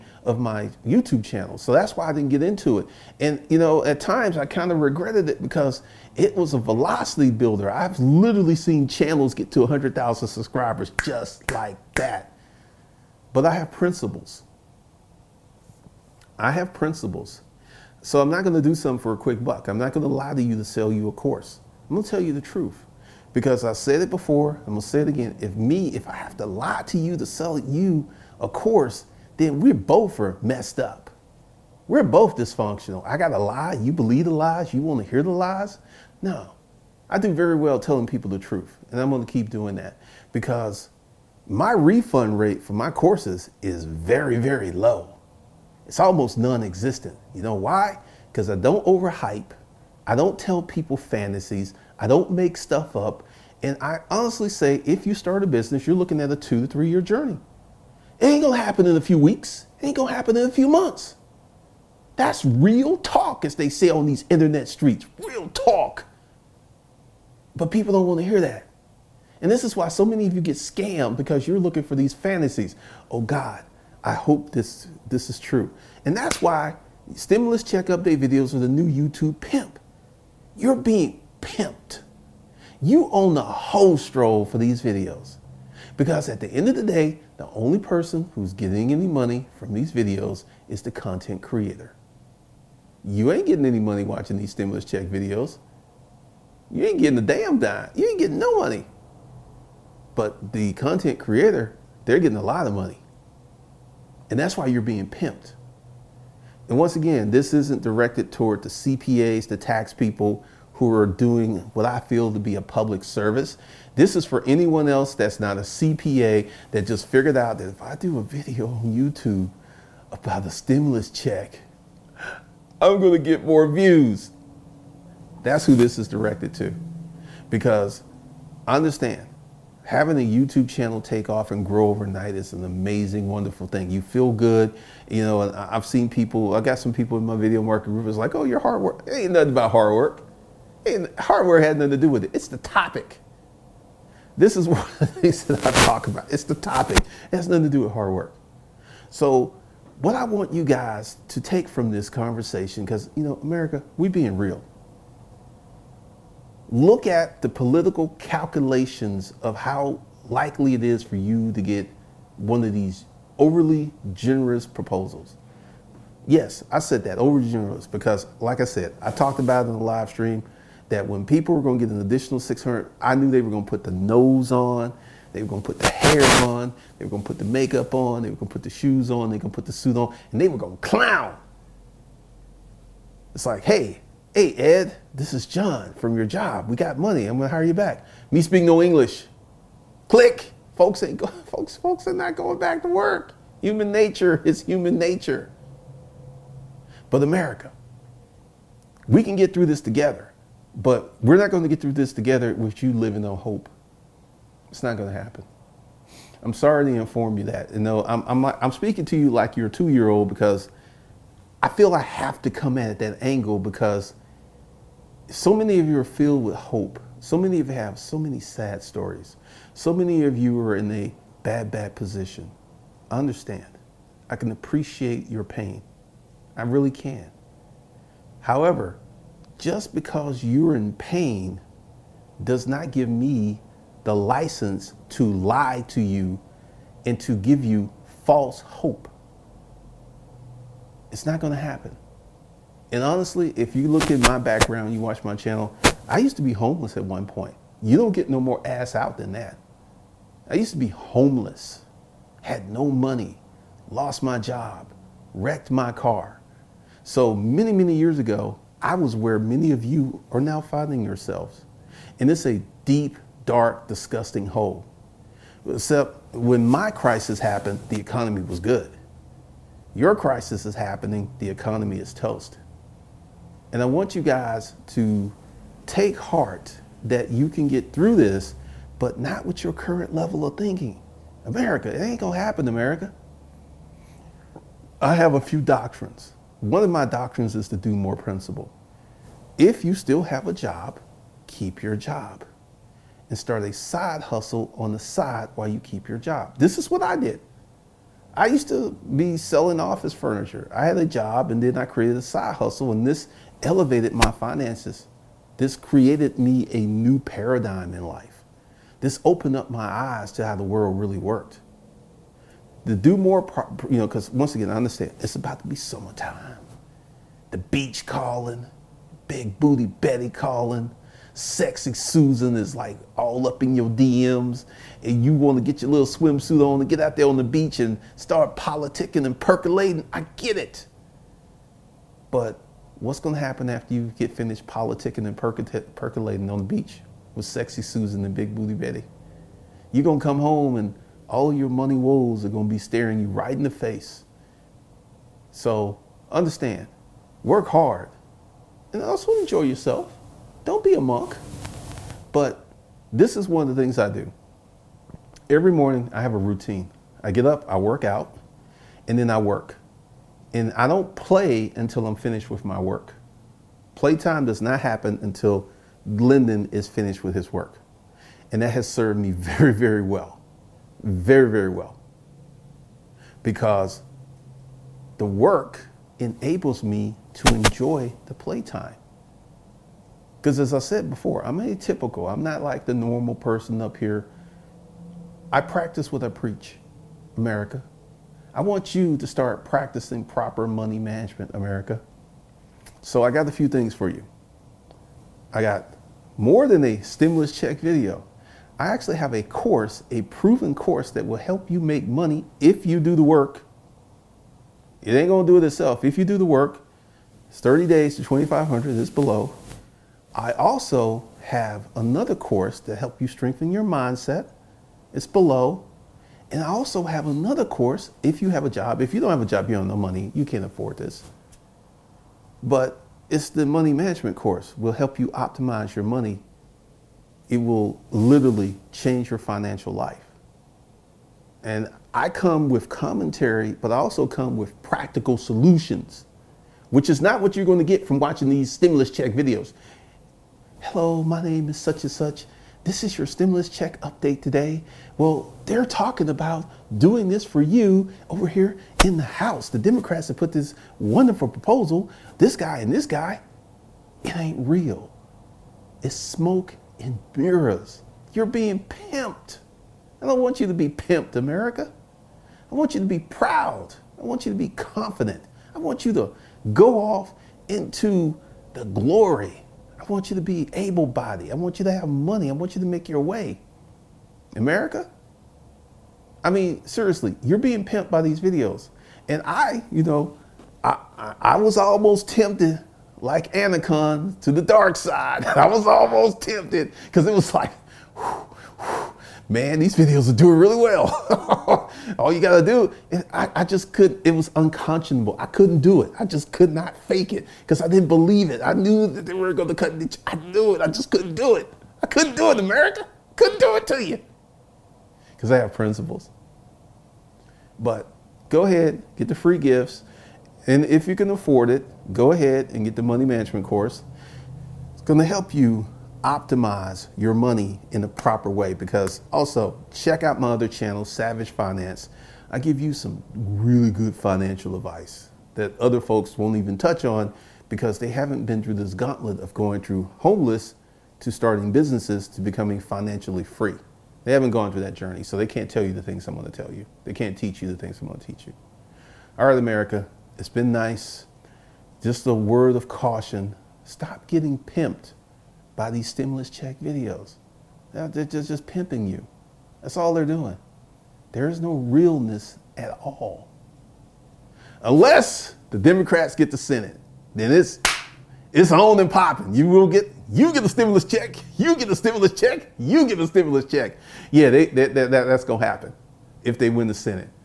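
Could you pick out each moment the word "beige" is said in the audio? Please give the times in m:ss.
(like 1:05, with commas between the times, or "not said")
not said.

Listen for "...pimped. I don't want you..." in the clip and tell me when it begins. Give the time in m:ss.
7:38.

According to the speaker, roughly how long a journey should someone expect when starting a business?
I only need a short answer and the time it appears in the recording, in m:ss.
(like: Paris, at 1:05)
2 to 3 years, at 0:56.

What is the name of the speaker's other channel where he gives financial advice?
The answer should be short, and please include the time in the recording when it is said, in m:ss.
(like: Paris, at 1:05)
Savage Finance, at 8:41.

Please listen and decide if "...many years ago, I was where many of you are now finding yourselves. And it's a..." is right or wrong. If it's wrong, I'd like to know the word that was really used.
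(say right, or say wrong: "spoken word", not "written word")
right.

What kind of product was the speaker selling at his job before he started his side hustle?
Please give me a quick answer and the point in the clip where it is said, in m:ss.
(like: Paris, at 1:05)
Office furniture, at 4:59.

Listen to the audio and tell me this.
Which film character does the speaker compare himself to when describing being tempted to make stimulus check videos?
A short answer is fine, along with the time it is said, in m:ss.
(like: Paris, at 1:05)
Anakin, at 8:03.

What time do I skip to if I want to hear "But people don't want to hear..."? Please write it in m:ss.
1:07.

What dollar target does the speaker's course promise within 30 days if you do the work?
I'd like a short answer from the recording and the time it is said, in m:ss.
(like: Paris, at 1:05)
2,500, at 6:48.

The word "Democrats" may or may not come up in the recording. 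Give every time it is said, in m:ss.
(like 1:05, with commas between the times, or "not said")
7:29, 9:15.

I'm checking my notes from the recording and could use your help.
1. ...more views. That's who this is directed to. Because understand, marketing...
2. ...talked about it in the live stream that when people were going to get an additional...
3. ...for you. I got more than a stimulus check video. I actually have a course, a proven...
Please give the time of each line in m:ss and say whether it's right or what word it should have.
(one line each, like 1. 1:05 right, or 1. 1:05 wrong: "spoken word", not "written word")
1. 2:03 wrong: "having", not "marketing"
2. 2:49 right
3. 6:33 right.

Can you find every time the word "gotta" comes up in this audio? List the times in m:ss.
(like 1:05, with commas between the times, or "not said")
0:33, 8:12.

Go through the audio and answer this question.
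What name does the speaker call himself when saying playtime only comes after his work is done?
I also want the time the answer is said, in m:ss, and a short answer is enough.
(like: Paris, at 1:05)
Glendon, at 6:06.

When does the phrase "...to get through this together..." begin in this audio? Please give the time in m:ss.
3:21.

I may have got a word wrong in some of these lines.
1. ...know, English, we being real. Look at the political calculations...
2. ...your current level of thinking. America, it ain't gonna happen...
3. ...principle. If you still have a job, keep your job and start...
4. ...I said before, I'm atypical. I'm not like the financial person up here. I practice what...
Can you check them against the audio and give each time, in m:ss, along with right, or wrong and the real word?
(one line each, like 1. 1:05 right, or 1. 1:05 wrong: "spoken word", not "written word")
1. 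2:33 wrong: "America", not "English"
2. 4:39 right
3. 4:48 right
4. 6:20 wrong: "normal", not "financial".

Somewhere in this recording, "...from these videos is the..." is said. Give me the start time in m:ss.
1:29.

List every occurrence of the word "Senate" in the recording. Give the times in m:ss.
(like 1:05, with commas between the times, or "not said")
9:16, 9:26.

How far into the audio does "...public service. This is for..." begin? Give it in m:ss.
1:52.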